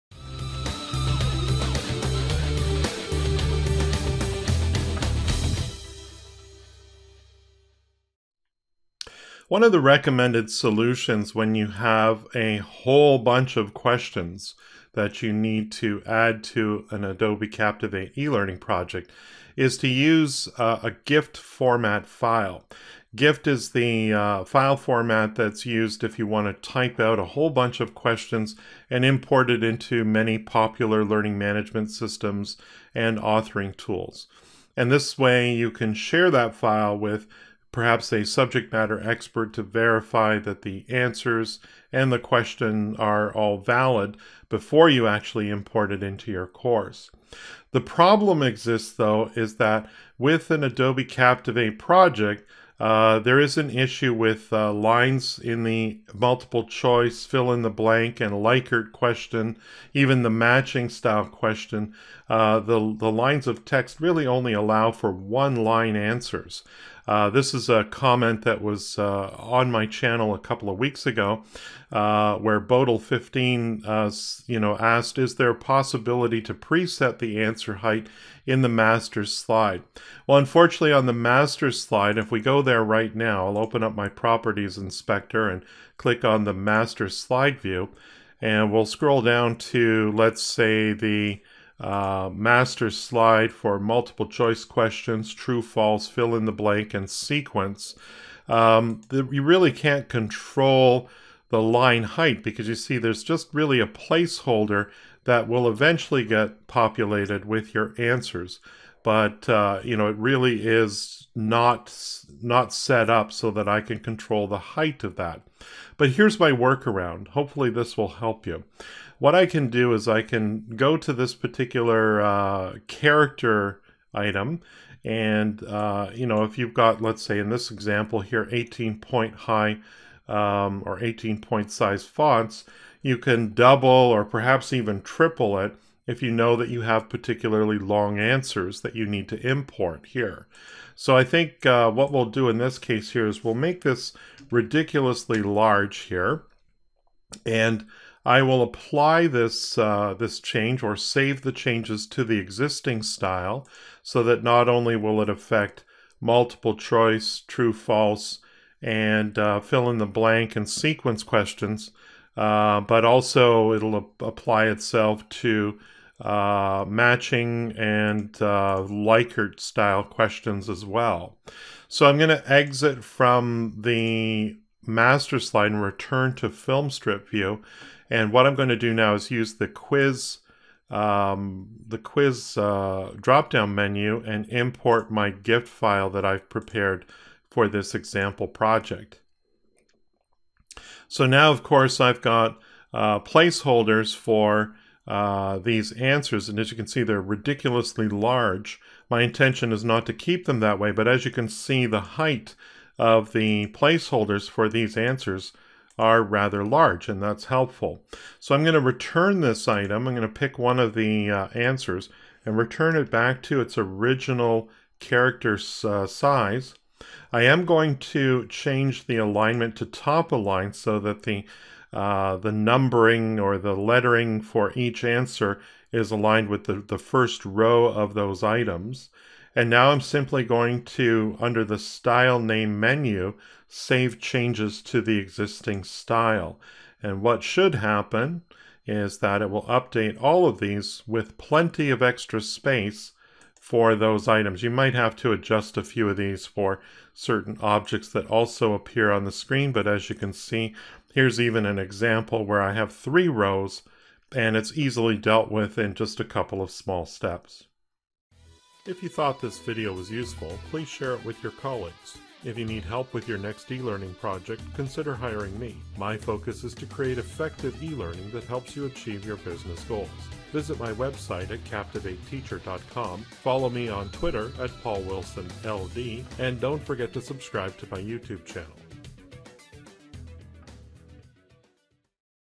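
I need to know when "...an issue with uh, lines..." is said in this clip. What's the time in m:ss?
0:53.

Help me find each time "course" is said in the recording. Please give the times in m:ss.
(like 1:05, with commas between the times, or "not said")
0:46, 3:11.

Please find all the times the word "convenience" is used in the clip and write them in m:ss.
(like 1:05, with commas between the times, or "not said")
not said.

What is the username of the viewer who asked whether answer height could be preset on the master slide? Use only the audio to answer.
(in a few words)
Bodil15.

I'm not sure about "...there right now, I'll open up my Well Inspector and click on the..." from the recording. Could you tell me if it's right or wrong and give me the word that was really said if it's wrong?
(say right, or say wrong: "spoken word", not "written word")
wrong: "Properties", not "Well".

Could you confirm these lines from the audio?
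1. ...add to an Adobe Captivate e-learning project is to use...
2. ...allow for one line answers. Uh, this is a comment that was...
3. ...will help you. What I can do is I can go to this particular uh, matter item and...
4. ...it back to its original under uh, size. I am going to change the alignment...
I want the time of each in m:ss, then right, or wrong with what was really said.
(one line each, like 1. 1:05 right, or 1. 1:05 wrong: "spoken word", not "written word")
1. 0:16 right
2. 1:04 right
3. 1:57 wrong: "character", not "matter"
4. 3:32 wrong: "character", not "under".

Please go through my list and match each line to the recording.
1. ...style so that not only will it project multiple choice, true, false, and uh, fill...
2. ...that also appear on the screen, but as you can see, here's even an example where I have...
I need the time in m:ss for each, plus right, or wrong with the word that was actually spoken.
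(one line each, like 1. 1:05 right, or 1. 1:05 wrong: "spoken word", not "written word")
1. 2:33 wrong: "affect", not "project"
2. 4:08 right.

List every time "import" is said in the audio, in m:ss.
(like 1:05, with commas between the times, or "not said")
0:29, 0:45, 2:19, 3:04.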